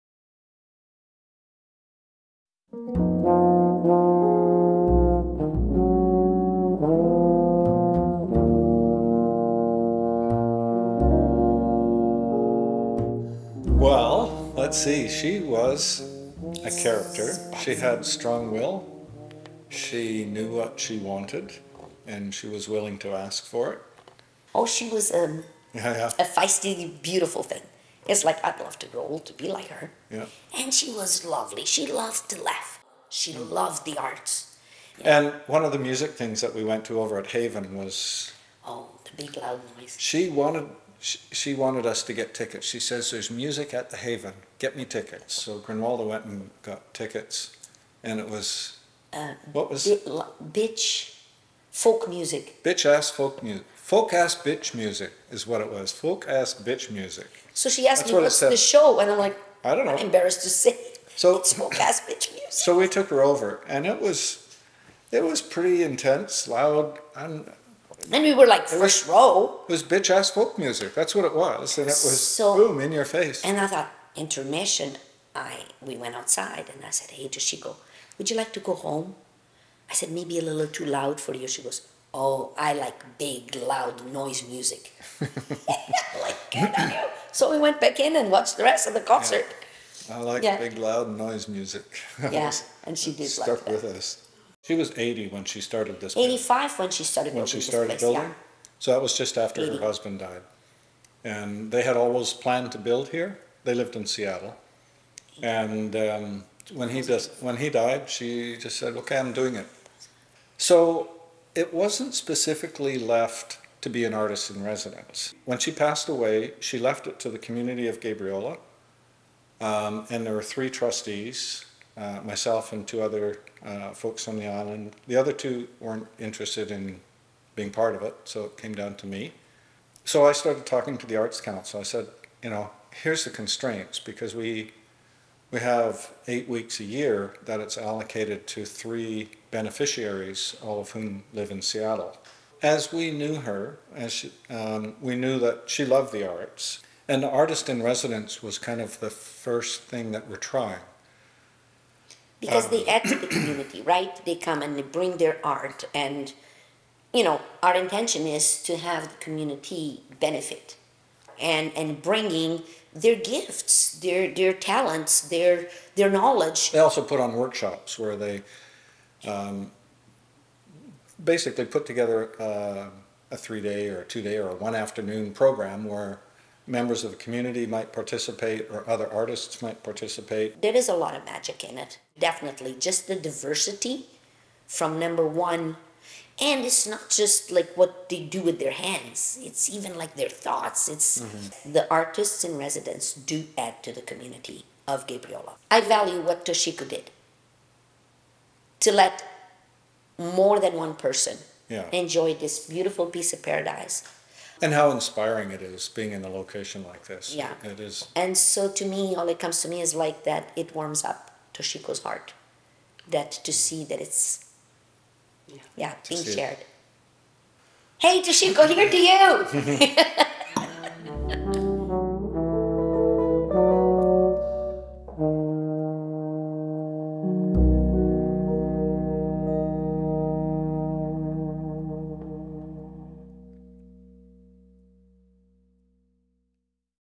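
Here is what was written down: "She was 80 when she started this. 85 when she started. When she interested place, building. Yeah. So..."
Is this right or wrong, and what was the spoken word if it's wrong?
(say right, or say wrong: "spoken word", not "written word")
wrong: "started", not "interested".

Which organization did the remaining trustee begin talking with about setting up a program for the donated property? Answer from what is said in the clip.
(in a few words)
Arts Council.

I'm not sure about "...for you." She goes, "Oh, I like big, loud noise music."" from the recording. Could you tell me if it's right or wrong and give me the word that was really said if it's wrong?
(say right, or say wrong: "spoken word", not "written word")
right.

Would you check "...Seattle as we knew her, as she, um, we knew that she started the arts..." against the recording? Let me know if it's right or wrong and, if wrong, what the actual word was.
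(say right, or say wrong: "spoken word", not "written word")
wrong: "loved", not "started".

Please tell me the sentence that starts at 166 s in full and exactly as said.
They also put on workshops where they.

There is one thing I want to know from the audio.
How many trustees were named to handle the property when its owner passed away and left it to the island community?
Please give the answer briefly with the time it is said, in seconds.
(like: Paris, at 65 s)
3, at 120 s.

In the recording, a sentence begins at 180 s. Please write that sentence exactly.
There is a lot of magic in it, definitely.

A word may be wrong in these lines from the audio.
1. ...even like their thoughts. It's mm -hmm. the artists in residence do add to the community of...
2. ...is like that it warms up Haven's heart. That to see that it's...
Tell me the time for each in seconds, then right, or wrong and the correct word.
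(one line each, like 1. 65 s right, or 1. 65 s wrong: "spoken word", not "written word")
1. 189 s right
2. 209 s wrong: "Toshiko", not "Haven".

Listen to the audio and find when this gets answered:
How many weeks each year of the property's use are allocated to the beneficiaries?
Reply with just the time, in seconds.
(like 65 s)
136 s.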